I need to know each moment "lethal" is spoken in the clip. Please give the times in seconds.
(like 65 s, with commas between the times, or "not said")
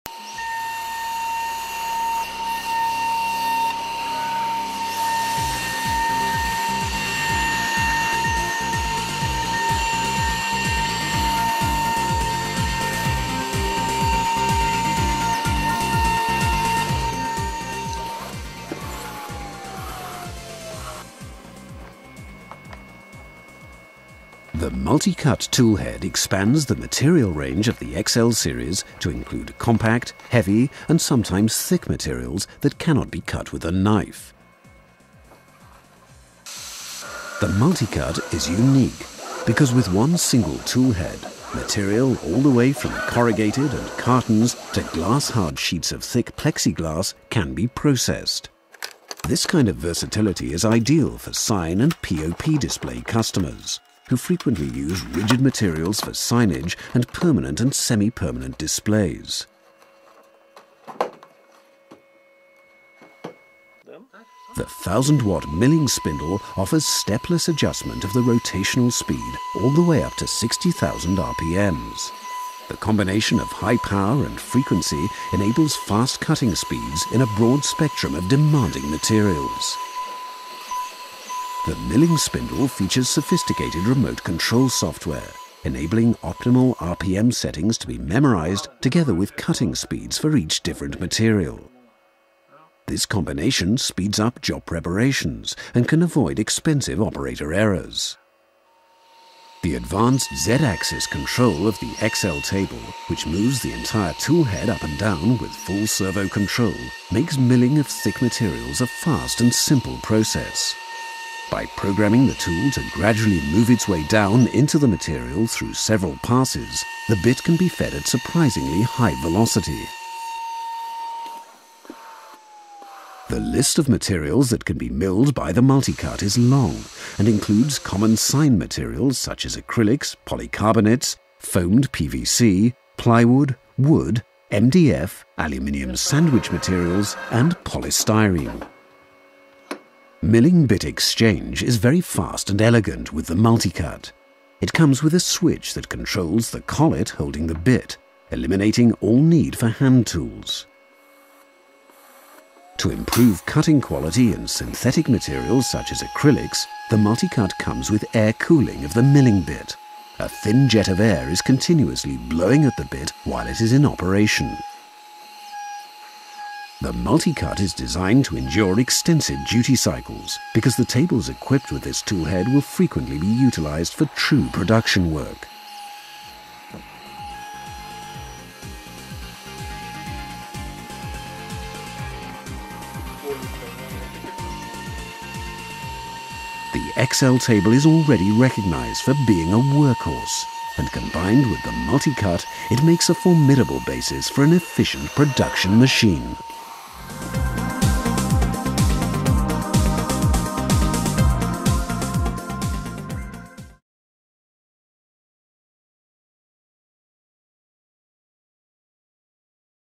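not said.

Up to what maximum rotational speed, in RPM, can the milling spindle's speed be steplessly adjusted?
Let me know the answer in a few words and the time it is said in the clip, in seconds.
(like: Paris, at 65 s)
60,000 RPM, at 70 s.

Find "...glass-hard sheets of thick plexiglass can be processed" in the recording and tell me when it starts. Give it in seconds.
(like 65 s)
44 s.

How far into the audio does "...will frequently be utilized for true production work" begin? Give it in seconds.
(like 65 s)
172 s.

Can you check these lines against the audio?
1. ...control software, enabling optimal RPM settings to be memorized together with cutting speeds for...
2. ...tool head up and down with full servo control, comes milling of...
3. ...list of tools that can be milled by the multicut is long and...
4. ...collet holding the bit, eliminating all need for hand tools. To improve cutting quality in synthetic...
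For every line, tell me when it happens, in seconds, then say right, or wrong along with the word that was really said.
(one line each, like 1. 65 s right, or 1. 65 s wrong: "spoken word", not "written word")
1. 84 s right
2. 104 s wrong: "makes", not "comes"
3. 123 s wrong: "materials", not "tools"
4. 146 s right.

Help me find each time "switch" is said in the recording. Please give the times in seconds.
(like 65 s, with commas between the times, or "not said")
145 s.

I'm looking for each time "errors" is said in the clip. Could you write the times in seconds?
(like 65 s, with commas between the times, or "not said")
97 s.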